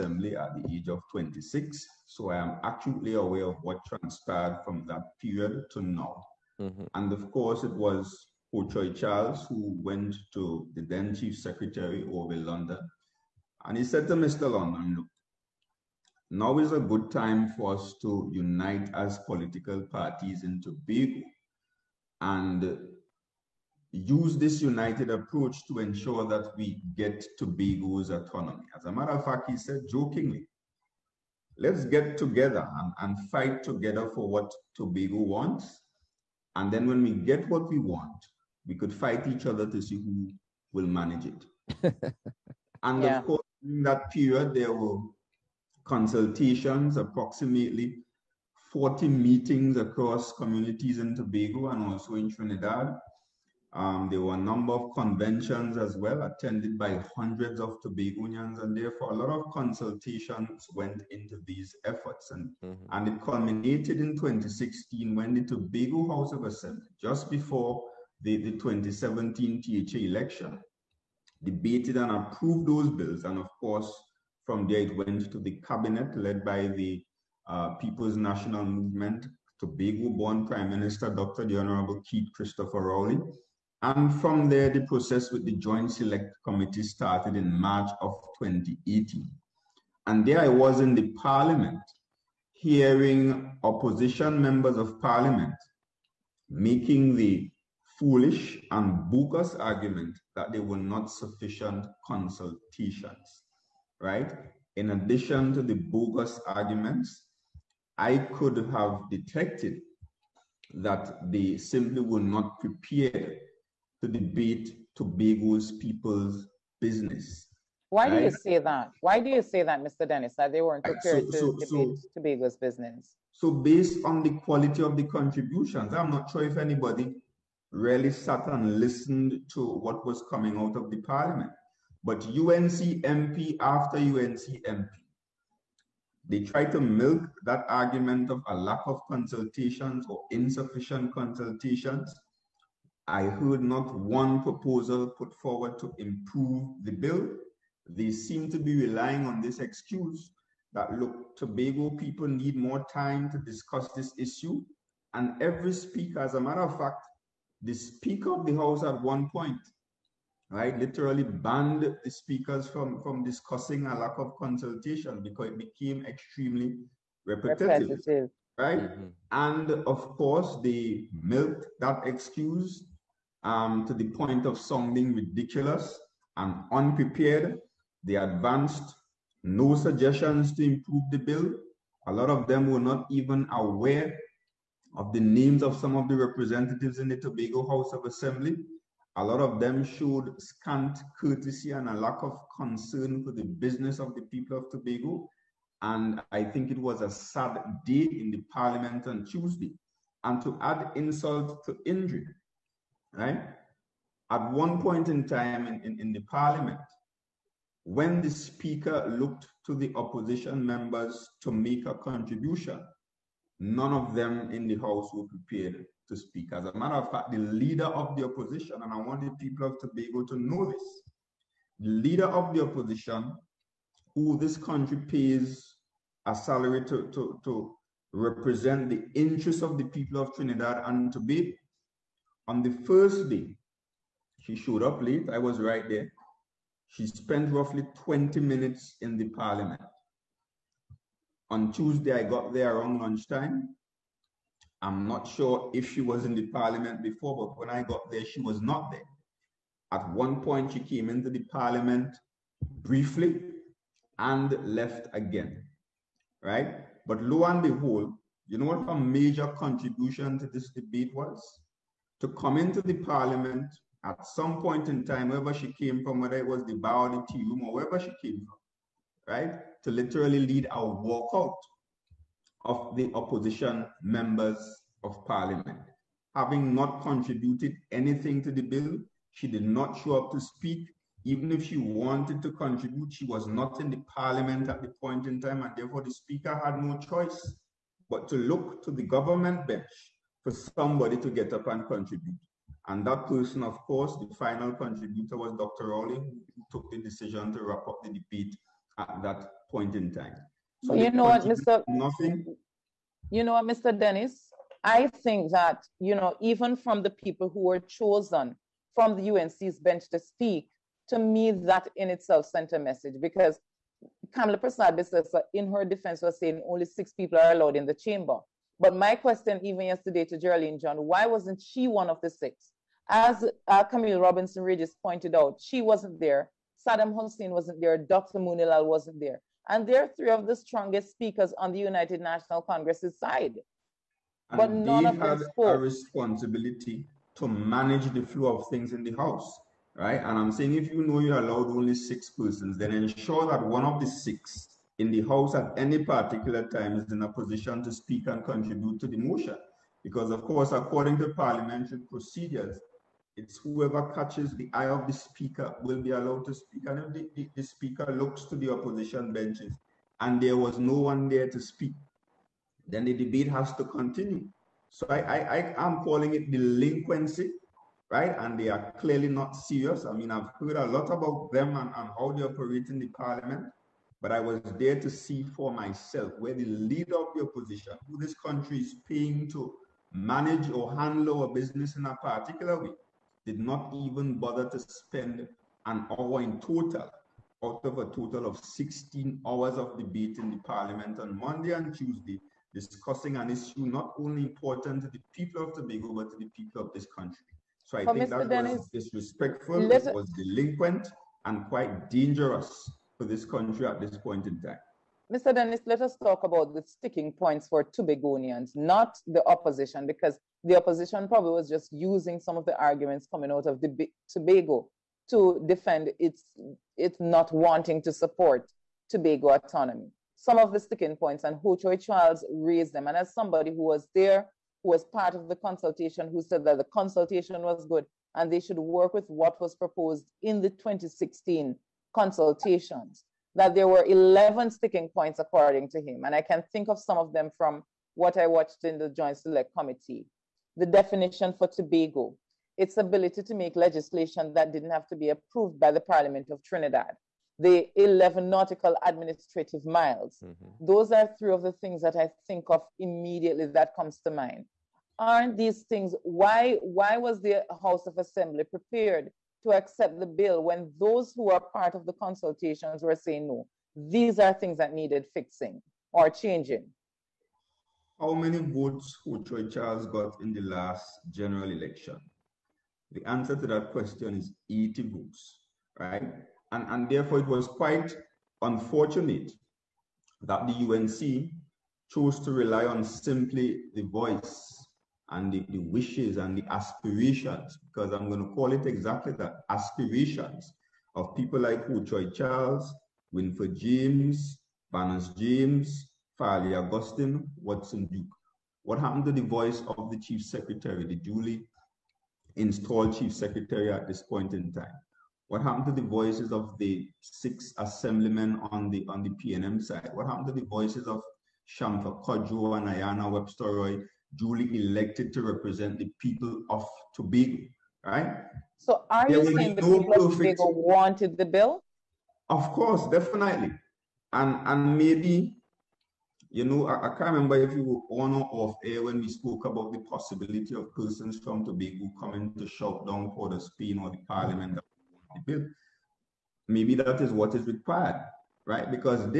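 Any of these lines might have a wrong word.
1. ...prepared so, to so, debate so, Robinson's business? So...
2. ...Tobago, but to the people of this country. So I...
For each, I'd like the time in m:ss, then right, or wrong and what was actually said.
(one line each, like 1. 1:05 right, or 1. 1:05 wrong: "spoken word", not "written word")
1. 2:00 wrong: "Tobago", not "Robinson"
2. 6:35 right.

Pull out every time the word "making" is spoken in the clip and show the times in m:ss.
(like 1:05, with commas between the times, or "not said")
1:36.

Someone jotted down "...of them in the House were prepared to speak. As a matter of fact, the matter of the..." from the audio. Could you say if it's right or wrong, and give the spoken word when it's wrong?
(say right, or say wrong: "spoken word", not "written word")
wrong: "leader", not "matter".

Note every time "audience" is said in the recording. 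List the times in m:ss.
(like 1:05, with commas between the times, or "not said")
not said.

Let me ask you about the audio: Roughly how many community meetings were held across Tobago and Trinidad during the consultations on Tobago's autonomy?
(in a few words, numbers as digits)
40.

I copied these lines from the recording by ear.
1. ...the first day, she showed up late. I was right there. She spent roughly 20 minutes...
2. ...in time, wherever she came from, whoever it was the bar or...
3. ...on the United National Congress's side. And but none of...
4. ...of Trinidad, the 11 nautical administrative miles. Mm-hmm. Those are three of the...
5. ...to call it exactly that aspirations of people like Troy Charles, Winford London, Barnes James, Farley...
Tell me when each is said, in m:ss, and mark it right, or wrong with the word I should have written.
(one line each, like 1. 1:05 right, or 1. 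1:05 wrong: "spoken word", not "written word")
1. 3:52 right
2. 4:24 wrong: "whether", not "whoever"
3. 5:31 right
4. 7:26 right
5. 8:08 wrong: "James", not "London".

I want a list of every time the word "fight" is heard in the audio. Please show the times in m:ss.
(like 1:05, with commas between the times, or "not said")
0:33, 0:38.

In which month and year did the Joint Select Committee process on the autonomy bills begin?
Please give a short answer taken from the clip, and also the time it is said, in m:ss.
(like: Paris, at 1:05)
March 2018, at 1:27.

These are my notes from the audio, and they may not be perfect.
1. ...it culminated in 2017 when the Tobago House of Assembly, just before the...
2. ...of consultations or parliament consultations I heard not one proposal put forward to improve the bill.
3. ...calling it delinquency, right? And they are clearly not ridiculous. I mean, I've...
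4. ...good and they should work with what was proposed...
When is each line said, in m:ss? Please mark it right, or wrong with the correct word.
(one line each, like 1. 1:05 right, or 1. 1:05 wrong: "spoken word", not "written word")
1. 1:03 wrong: "2016", not "2017"
2. 2:18 wrong: "insufficient", not "parliament"
3. 6:06 wrong: "serious", not "ridiculous"
4. 7:07 right.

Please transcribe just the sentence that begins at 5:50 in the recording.
Because, of course, according to parliamentary procedures, it's whoever catches the eye of the speaker will be allowed to speak.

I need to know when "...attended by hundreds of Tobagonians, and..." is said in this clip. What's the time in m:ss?
0:56.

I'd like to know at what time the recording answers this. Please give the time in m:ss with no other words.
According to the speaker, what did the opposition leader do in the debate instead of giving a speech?
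4:30.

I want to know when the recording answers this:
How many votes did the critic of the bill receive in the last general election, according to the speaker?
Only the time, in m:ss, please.
7:54.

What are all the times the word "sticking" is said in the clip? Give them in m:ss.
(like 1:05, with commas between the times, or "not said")
6:46, 7:00, 7:14.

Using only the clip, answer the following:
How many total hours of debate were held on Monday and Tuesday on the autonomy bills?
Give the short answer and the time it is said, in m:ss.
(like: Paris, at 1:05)
16, at 6:28.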